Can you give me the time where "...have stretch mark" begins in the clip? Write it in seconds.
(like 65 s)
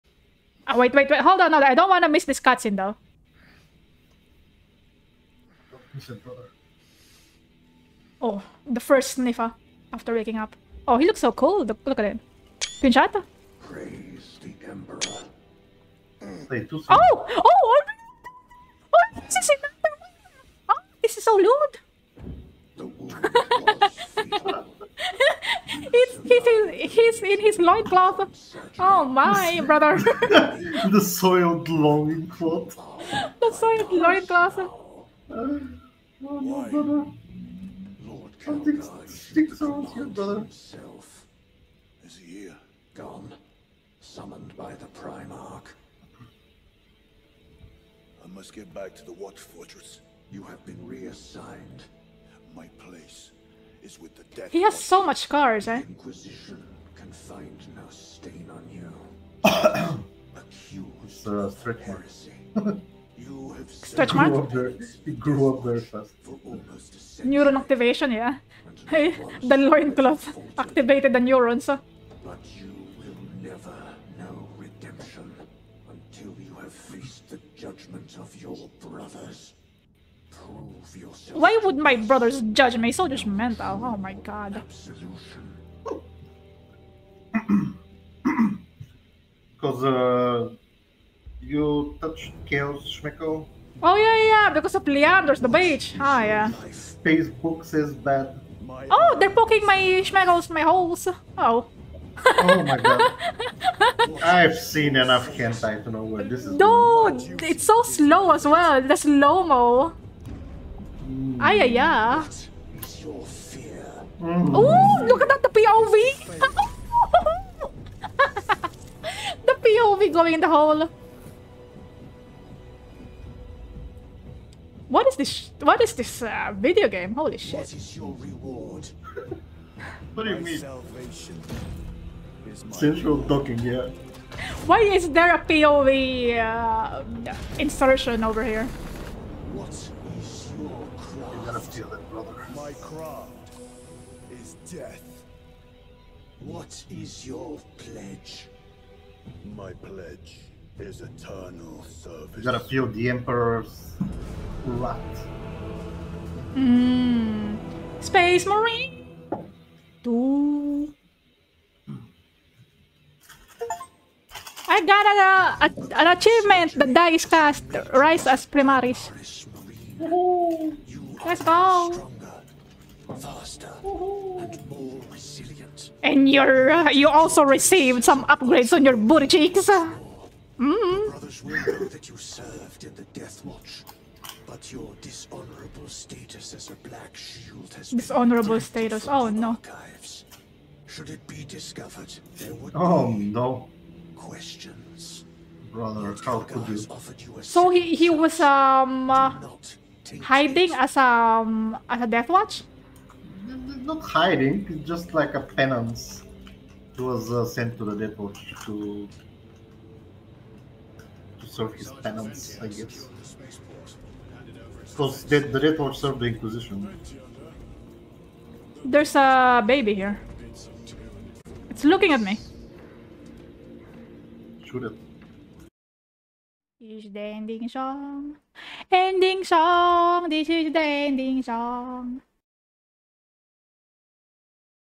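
63 s.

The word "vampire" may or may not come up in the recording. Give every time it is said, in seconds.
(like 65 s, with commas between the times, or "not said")
not said.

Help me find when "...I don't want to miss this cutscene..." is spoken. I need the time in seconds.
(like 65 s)
1 s.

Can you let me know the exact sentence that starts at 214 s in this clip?
Because the, the Death Watch served the Inquisition.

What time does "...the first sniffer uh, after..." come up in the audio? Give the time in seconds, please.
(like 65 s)
8 s.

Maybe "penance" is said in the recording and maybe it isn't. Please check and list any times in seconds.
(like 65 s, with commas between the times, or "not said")
205 s, 212 s.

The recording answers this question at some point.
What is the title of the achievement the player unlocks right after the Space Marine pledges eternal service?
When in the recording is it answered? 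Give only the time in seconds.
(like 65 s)
167 s.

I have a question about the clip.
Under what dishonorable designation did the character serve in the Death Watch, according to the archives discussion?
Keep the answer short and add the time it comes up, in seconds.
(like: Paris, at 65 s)
Black Shield, at 186 s.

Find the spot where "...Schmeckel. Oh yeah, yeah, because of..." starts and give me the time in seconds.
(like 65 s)
92 s.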